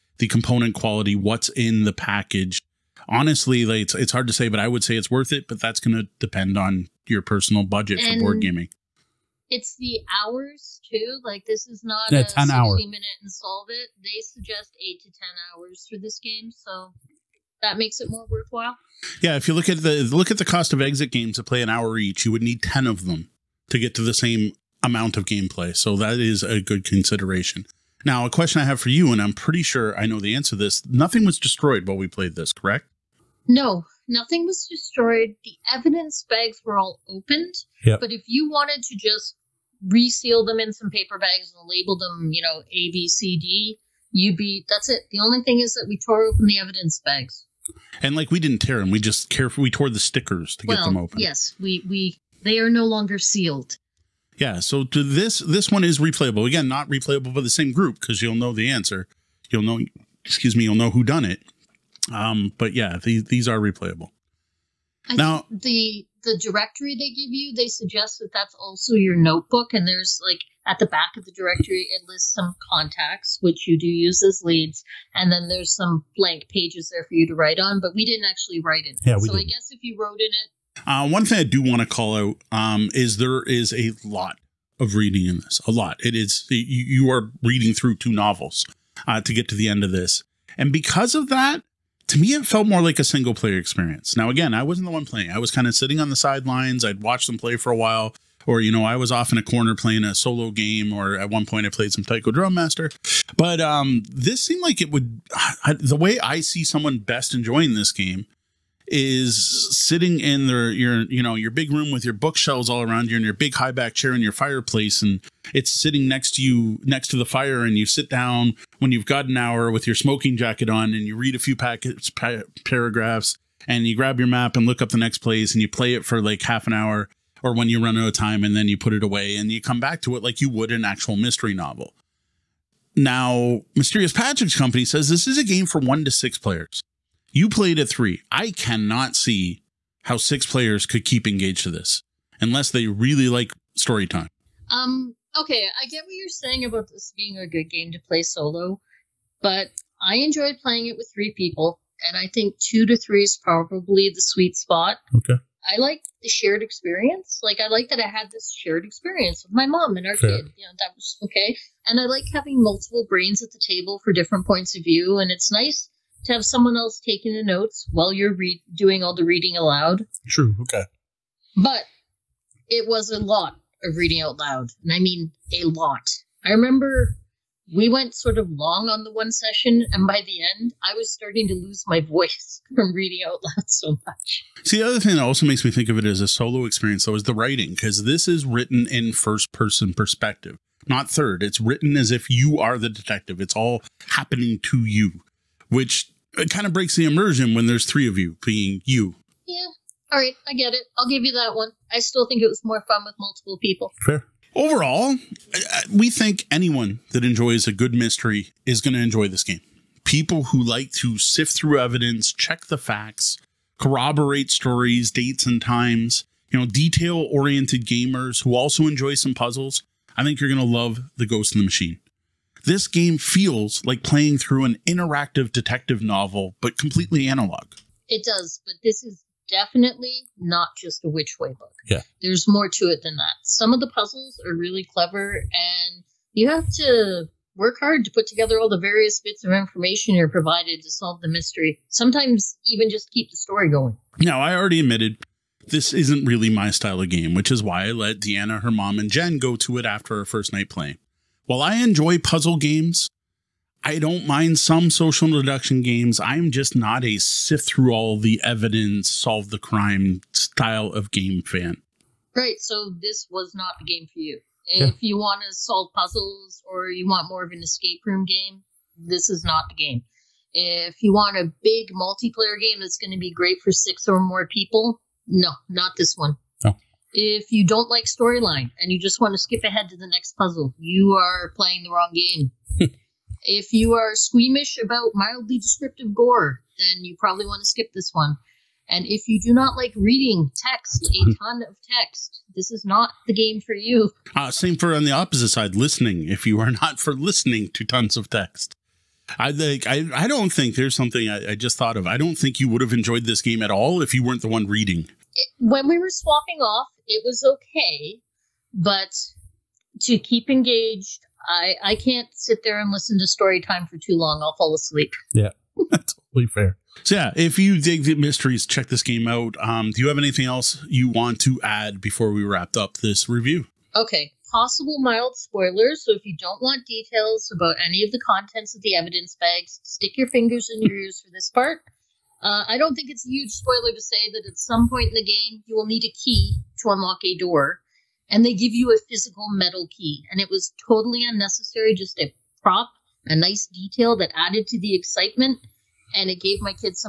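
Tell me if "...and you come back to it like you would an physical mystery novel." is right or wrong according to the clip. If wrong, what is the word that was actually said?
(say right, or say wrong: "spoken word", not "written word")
wrong: "actual", not "physical".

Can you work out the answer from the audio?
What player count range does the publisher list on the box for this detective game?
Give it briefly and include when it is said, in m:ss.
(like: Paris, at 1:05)
1 to 6 players, at 2:15.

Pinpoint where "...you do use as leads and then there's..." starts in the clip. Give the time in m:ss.
1:13.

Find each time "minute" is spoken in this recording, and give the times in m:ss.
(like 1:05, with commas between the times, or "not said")
0:12.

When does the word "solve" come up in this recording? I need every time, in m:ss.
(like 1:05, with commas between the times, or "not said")
0:13, 4:00, 4:19, 4:25.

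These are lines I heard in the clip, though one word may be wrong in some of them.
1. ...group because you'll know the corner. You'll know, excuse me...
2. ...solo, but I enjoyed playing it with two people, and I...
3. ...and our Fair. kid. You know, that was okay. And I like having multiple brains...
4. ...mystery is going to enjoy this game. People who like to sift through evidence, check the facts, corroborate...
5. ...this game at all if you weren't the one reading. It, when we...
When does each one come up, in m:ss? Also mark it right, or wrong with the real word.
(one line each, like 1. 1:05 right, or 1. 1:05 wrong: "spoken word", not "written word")
1. 0:57 wrong: "answer", not "corner"
2. 2:28 wrong: "three", not "two"
3. 2:39 right
4. 3:27 right
5. 5:03 right.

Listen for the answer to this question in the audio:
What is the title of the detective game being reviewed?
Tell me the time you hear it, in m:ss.
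3:41.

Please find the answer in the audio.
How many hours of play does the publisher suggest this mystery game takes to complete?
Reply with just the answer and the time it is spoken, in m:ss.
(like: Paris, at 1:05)
8 to 10 hours, at 0:14.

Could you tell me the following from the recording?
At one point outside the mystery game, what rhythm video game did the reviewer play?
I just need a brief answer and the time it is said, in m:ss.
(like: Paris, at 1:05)
Taiko Drum Master, at 1:42.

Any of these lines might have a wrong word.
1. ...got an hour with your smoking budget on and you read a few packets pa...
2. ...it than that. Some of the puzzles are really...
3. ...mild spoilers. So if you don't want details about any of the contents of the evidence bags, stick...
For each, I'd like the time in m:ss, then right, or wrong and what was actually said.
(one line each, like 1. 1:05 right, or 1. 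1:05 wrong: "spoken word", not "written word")
1. 1:59 wrong: "jacket", not "budget"
2. 3:52 right
3. 5:25 right.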